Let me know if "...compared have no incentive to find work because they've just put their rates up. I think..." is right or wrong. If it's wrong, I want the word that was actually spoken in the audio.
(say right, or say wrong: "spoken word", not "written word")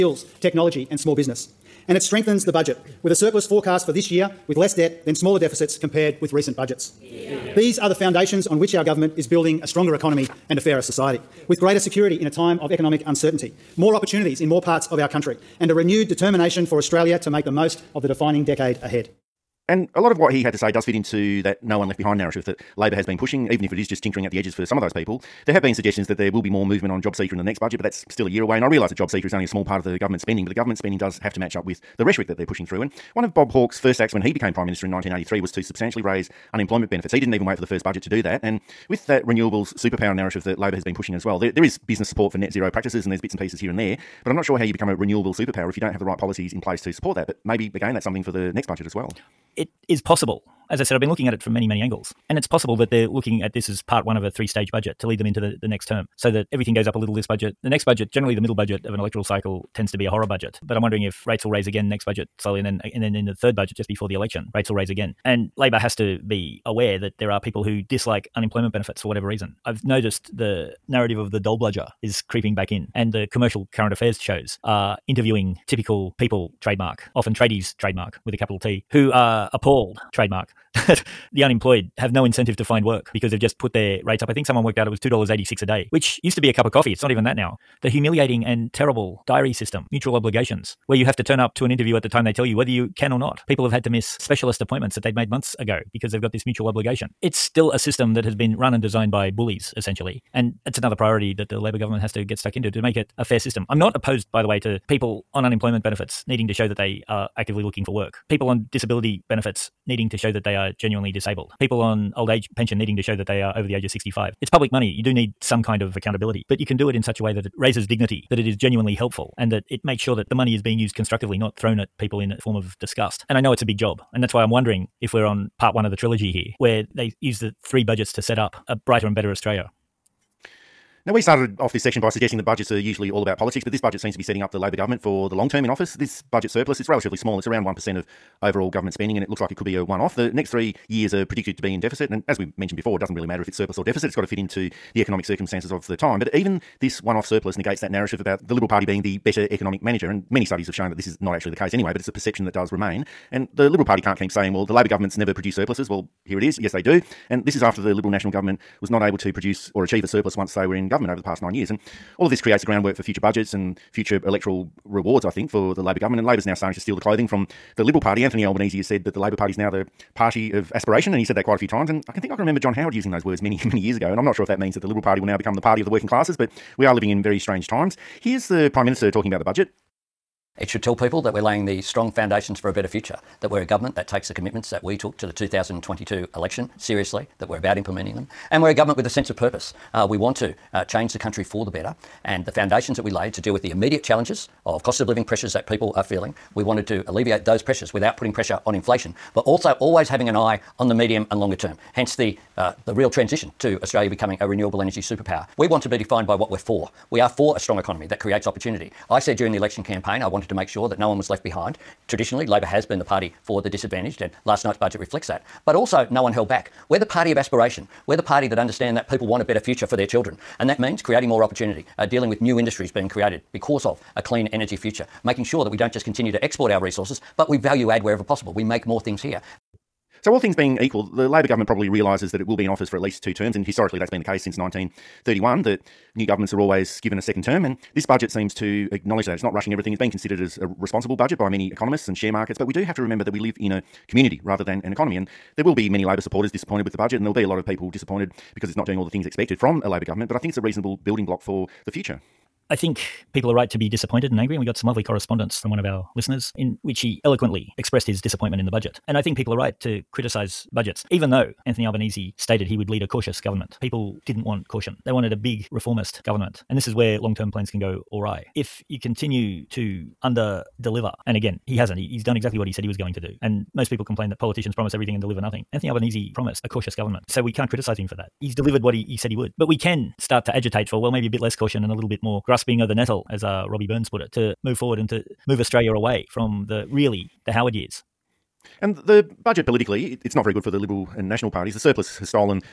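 wrong: "unemployed", not "compared".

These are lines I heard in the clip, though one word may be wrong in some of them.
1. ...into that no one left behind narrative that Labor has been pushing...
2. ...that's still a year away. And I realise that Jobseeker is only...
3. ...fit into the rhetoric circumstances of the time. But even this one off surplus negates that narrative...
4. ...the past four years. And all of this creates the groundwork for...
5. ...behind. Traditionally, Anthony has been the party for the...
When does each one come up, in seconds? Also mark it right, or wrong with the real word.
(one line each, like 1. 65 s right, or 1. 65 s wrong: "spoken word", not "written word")
1. 20 s right
2. 27 s right
3. 144 s wrong: "economic", not "rhetoric"
4. 161 s wrong: "nine", not "four"
5. 211 s wrong: "Labor", not "Anthony".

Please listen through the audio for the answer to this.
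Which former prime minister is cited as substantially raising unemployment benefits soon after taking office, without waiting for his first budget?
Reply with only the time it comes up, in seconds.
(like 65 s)
33 s.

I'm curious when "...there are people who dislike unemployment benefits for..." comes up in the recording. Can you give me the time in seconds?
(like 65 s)
67 s.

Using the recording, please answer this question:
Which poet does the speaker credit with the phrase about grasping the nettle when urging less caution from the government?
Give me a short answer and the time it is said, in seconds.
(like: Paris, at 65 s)
Robbie Burns, at 283 s.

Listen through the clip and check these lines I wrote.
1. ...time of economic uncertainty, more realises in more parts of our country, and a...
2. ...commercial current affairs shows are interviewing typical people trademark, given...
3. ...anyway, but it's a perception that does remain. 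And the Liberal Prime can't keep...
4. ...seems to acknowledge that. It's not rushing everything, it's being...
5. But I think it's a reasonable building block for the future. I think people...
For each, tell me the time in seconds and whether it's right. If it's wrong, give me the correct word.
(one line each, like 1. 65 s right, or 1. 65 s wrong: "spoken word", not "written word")
1. 12 s wrong: "opportunities", not "realises"
2. 73 s wrong: "often", not "given"
3. 151 s wrong: "Party", not "Prime"
4. 238 s right
5. 250 s right.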